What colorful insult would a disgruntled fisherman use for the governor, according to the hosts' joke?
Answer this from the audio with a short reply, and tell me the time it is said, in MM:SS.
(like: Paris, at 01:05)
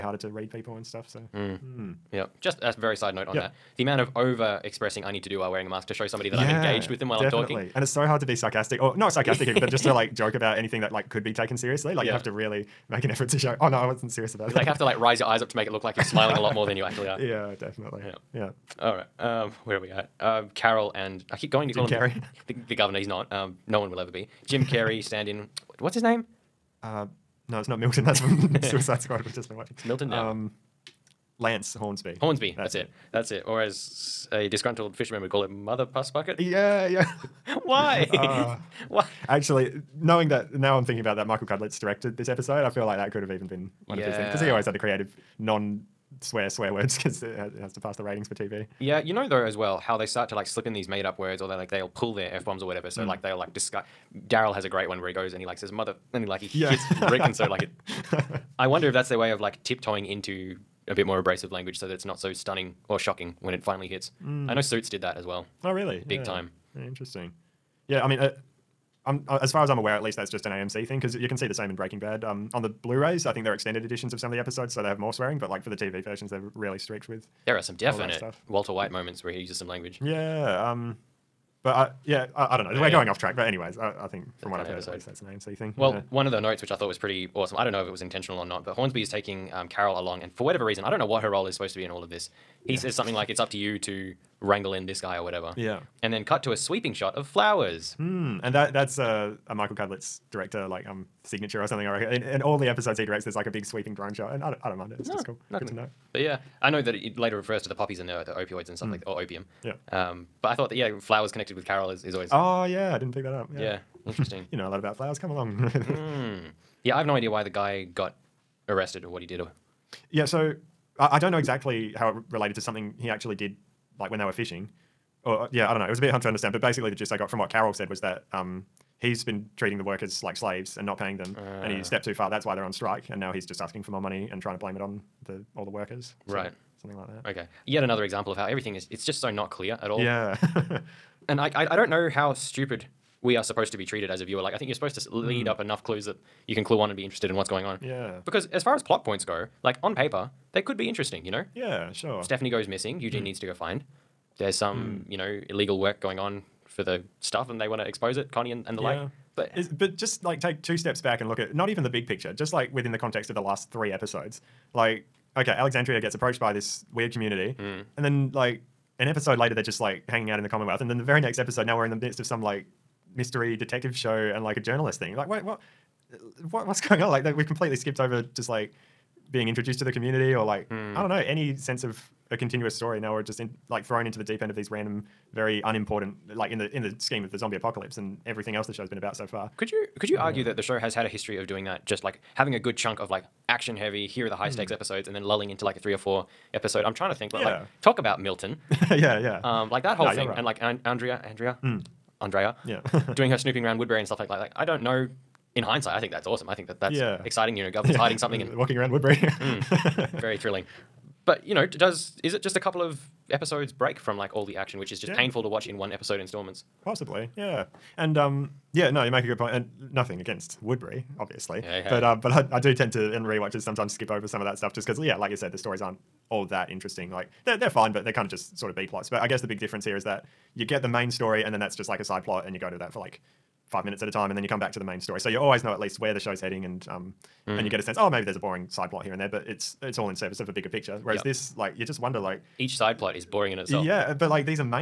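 mother puss bucket, at 00:35.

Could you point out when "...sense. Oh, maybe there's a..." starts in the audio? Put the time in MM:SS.
03:57.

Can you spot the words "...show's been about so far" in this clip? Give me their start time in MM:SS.
03:08.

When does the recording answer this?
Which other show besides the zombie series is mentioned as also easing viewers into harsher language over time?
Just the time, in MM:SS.
01:04.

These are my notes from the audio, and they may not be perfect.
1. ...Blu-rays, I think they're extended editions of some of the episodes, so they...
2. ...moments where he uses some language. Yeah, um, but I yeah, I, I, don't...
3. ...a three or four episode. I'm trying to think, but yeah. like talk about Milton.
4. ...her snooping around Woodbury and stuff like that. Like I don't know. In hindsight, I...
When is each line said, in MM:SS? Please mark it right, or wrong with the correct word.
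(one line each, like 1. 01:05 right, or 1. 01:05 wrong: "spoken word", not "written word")
1. 01:12 right
2. 01:18 right
3. 03:15 right
4. 03:23 right.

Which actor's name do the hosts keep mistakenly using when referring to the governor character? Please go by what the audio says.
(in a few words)
Jim Carrey.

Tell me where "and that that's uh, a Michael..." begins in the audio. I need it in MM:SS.
01:38.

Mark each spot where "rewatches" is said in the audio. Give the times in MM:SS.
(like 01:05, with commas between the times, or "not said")
03:43.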